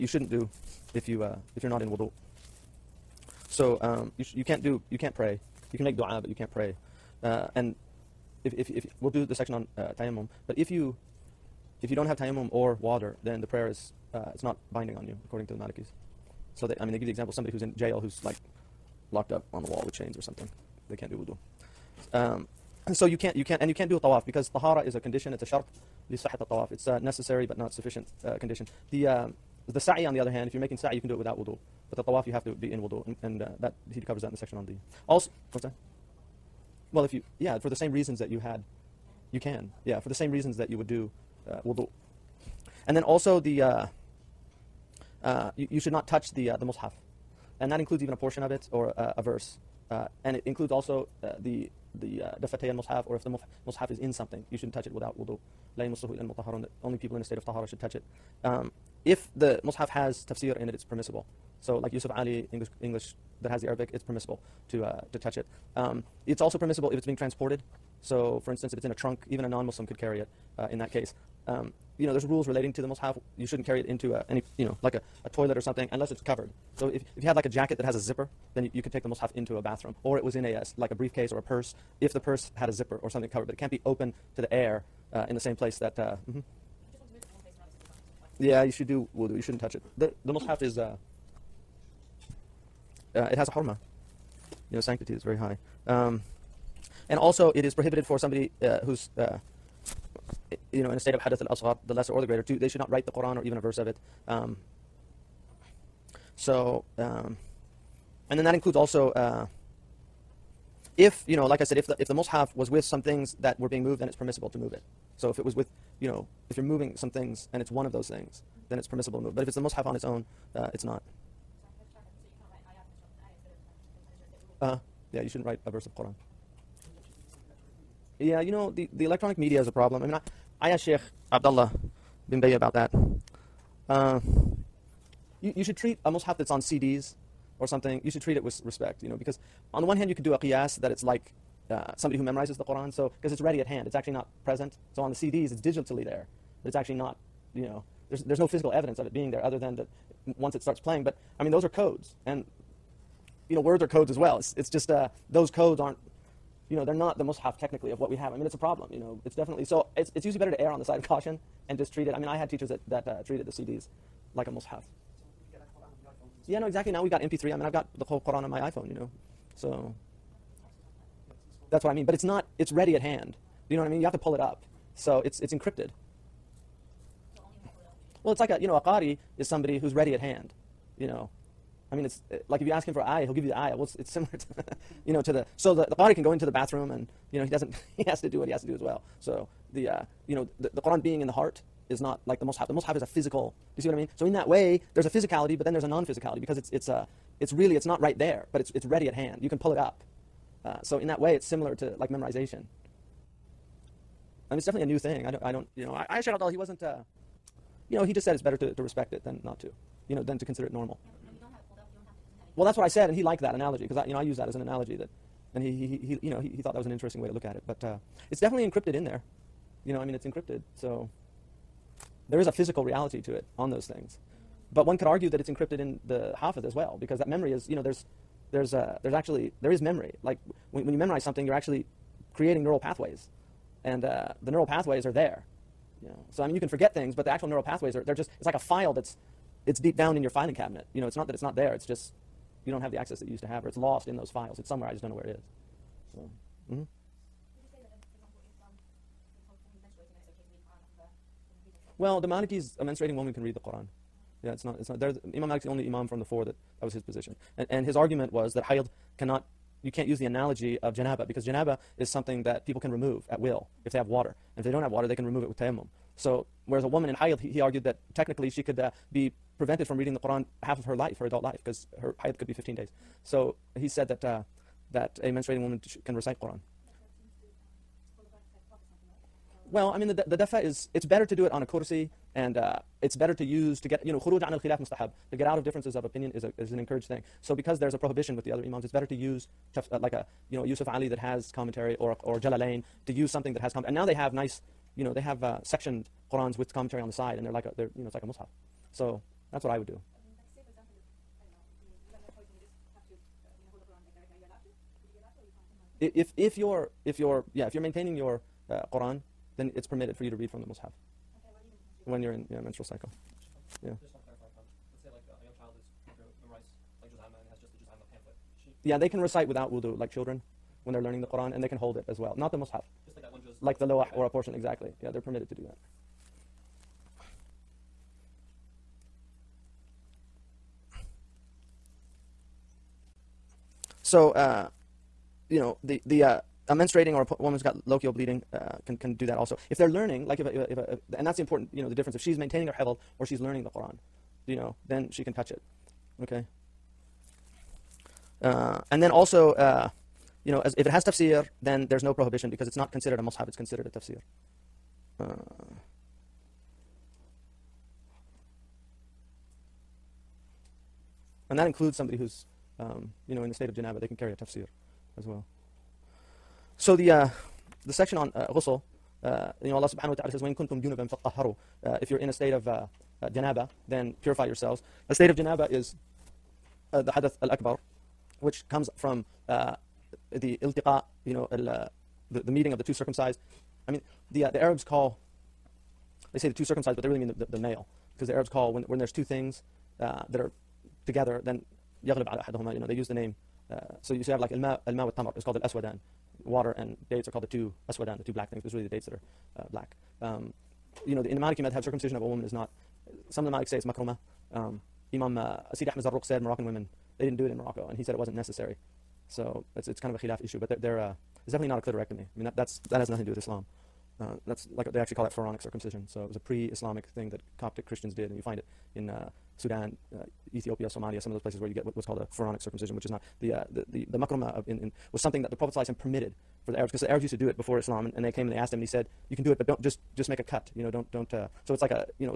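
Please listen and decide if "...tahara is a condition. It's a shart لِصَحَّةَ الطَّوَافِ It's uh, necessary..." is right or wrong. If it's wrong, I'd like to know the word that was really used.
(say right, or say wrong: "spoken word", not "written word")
right.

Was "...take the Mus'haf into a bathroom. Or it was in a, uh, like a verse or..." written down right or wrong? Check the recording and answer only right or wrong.
wrong.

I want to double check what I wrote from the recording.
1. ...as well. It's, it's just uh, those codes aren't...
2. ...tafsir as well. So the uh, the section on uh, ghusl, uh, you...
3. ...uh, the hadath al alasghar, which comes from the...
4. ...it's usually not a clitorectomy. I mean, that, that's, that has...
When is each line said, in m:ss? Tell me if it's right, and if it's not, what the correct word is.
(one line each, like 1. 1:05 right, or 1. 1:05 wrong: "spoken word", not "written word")
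1. 2:34 right
2. 6:04 right
3. 6:16 wrong: "akbar", not "alasghar"
4. 6:51 wrong: "definitely", not "usually".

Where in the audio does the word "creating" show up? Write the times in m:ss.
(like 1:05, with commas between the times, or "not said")
3:52.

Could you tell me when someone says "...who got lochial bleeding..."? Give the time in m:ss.
5:37.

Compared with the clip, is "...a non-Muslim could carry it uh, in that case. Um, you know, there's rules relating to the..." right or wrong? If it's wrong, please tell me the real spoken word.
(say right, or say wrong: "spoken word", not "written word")
right.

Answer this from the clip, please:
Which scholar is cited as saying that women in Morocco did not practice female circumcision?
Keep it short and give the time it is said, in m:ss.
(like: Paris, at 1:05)
Sidi Ahmed Zarruq, at 6:45.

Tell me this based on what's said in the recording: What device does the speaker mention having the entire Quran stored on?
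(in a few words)
iPhone.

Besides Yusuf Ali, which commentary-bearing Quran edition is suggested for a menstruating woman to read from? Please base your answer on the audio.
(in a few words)
Jalalain.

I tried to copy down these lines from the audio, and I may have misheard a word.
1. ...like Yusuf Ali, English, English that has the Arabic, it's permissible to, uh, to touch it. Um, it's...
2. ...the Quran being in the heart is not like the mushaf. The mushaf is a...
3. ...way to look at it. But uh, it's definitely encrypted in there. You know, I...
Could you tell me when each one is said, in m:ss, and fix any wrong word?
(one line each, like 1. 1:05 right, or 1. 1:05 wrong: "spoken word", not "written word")
1. 1:01 right
2. 3:10 right
3. 3:37 right.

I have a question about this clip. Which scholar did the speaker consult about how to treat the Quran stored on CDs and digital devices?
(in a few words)
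Sheikh Abdullah bin Bayyah.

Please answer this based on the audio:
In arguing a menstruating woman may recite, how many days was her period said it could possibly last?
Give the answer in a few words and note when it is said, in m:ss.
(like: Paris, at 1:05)
15, at 4:32.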